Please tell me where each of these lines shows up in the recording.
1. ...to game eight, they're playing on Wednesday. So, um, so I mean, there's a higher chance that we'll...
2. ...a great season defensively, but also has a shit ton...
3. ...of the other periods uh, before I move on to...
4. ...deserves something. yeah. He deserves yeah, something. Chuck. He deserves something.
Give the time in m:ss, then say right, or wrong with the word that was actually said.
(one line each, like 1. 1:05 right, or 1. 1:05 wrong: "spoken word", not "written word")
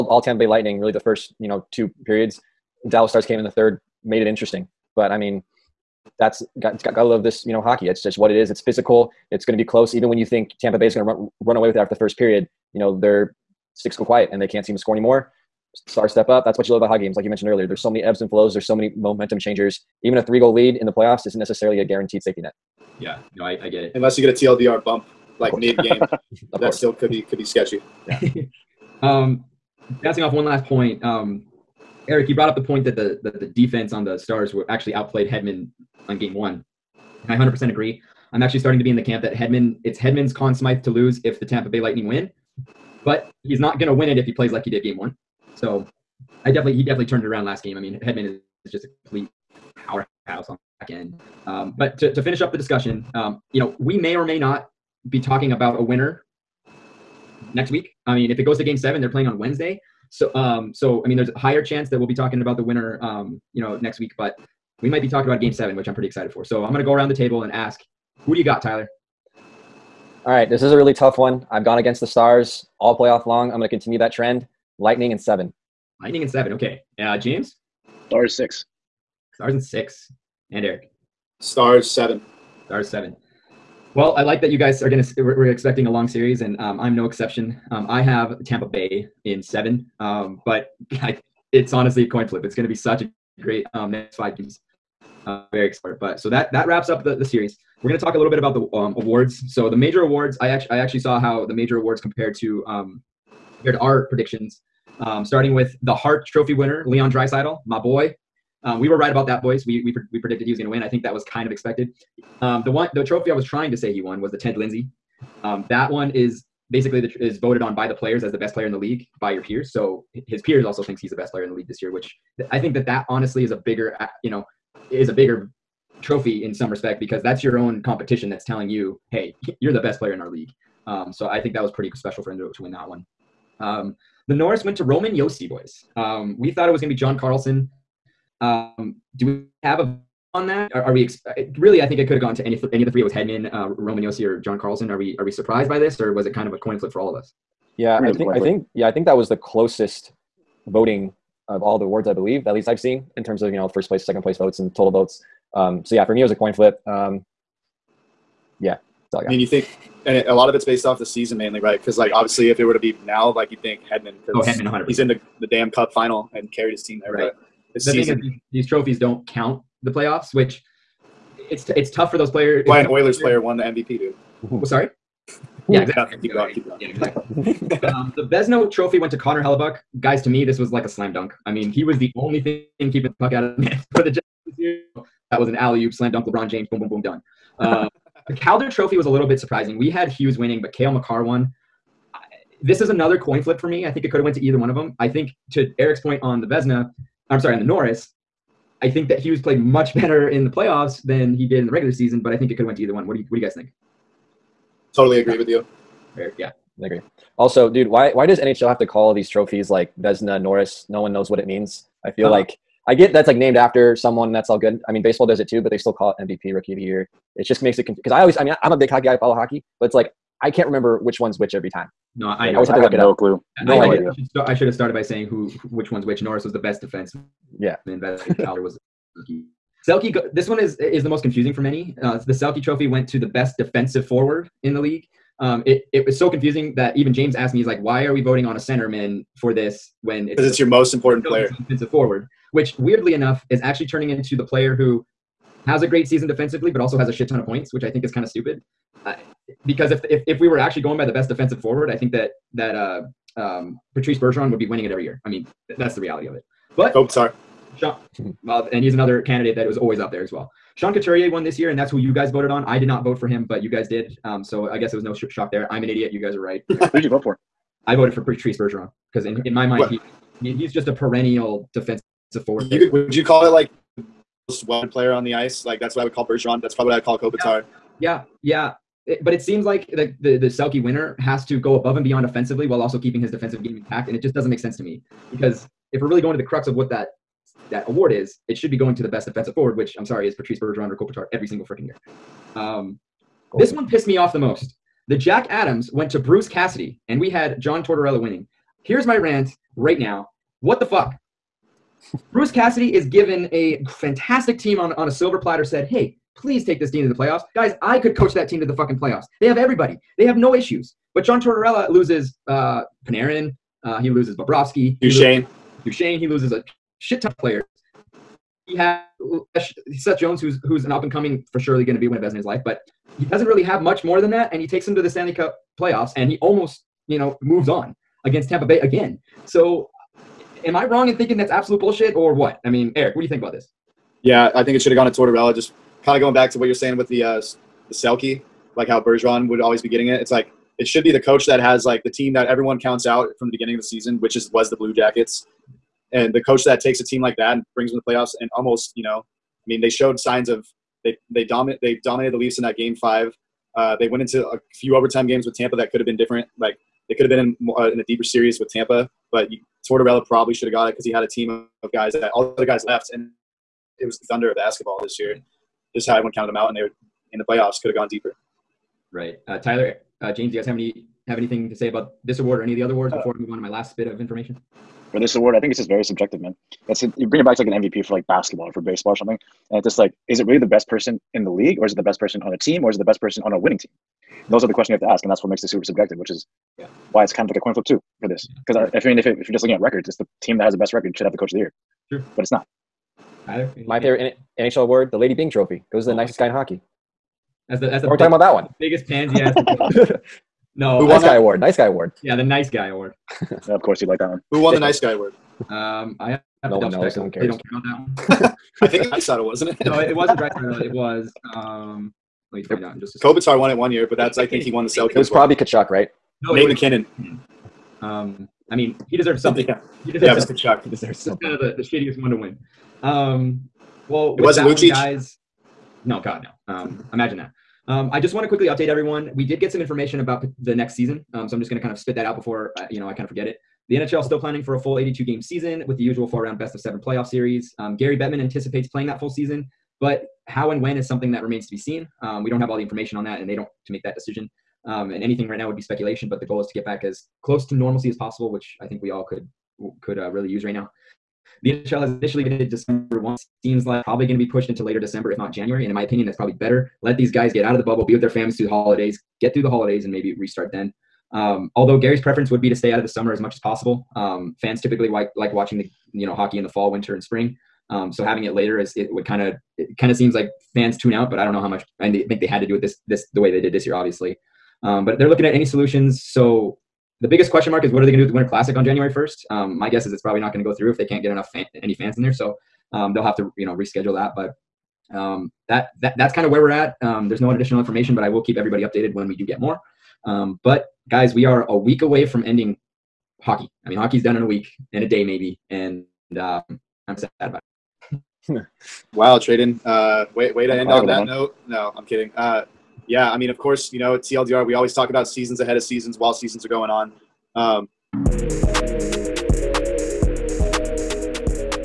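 1. 0:58 wrong: "seven", not "eight"
2. 4:05 right
3. 6:12 wrong: "awards", not "periods"
4. 6:59 right.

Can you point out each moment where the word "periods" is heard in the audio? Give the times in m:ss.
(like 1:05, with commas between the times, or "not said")
0:02, 0:12.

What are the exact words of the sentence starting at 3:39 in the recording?
I follow hockey, but it's like I can't remember which one's which every time.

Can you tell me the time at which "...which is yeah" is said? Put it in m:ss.
6:26.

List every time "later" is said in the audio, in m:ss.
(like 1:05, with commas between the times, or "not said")
7:34, 7:48.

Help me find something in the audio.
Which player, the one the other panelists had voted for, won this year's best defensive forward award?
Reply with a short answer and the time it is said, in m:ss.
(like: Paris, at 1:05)
Sean Couturier, at 4:20.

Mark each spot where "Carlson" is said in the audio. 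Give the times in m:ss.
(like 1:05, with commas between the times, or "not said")
2:17, 2:24.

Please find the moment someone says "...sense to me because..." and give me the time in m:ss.
4:44.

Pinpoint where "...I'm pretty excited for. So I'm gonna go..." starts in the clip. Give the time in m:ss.
1:05.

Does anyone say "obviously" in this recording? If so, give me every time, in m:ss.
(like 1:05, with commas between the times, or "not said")
2:42, 7:53.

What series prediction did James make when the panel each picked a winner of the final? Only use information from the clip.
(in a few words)
Stars in 6.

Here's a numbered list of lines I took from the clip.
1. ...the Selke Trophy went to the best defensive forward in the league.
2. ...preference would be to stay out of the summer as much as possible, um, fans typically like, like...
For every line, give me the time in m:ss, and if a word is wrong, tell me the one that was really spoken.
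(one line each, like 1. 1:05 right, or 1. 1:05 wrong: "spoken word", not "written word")
1. 3:52 right
2. 7:42 right.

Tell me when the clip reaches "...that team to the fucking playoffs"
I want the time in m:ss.
5:08.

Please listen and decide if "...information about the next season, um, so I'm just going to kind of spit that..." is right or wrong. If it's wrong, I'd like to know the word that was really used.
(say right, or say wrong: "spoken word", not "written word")
right.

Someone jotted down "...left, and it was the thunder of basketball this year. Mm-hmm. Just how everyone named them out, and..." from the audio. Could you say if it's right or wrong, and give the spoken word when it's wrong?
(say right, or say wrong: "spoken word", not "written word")
wrong: "counted", not "named".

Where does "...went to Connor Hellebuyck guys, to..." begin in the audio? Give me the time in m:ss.
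2:58.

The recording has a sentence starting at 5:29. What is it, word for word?
So, am I wrong in thinking that's absolute bullshit or what?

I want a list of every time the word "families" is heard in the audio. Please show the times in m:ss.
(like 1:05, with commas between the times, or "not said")
7:38.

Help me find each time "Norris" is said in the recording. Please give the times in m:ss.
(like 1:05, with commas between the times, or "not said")
2:14, 3:17, 3:30, 3:46.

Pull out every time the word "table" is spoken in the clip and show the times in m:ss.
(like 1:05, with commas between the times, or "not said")
1:07.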